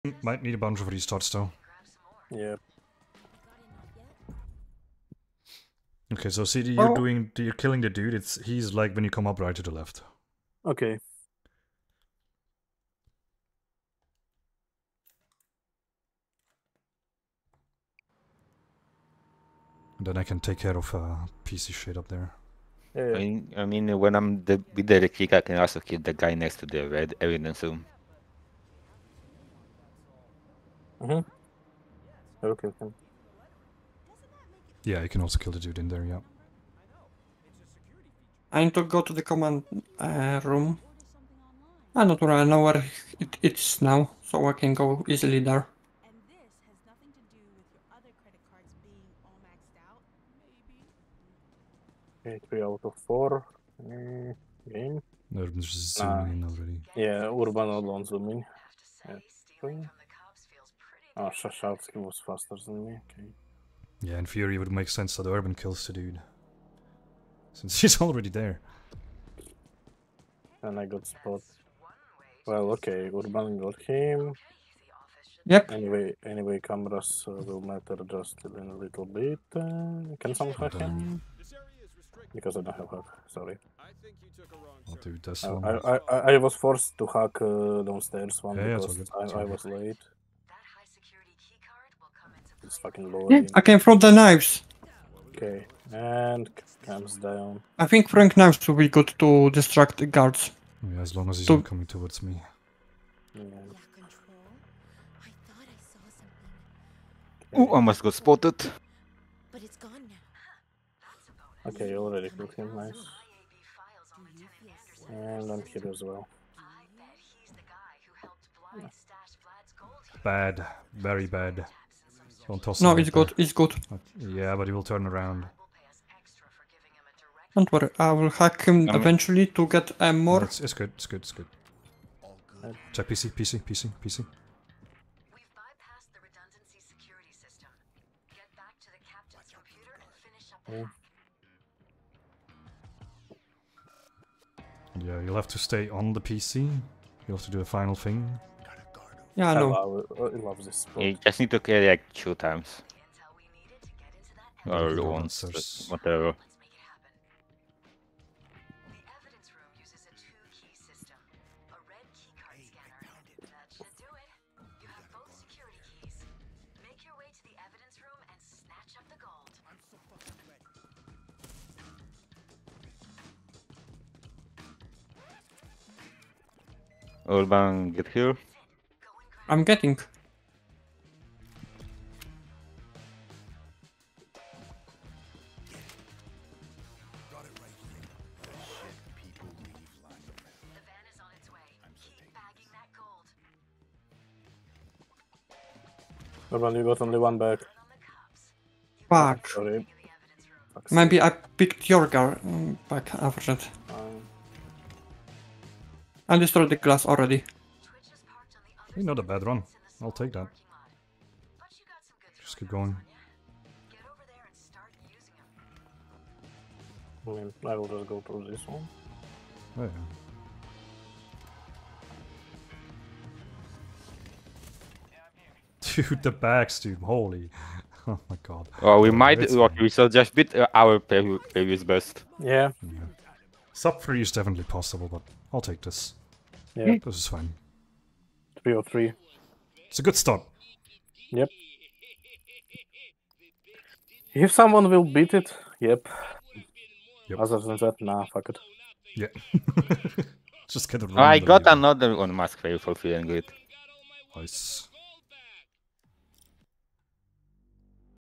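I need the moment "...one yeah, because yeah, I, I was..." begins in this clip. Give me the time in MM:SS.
01:28.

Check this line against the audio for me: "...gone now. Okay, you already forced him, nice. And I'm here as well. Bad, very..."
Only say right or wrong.
wrong.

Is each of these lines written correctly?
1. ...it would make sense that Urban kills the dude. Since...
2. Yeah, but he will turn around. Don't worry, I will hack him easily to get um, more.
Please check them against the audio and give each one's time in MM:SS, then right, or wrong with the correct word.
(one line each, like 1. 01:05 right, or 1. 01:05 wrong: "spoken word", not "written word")
1. 01:04 right
2. 02:04 wrong: "eventually", not "easily".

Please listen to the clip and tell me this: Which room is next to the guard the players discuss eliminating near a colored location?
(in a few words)
red evidence room.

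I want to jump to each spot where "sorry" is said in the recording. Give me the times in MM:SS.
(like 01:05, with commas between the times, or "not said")
01:23, 03:19.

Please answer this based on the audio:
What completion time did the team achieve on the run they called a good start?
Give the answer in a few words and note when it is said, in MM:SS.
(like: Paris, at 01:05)
303, at 03:58.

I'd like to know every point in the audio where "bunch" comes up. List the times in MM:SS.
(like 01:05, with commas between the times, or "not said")
00:00.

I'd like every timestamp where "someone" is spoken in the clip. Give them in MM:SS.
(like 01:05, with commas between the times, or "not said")
01:20, 04:04.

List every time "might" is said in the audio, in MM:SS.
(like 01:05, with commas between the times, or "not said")
00:00, 03:49.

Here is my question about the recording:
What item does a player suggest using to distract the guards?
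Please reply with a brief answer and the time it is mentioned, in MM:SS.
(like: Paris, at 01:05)
Frank knives, at 01:38.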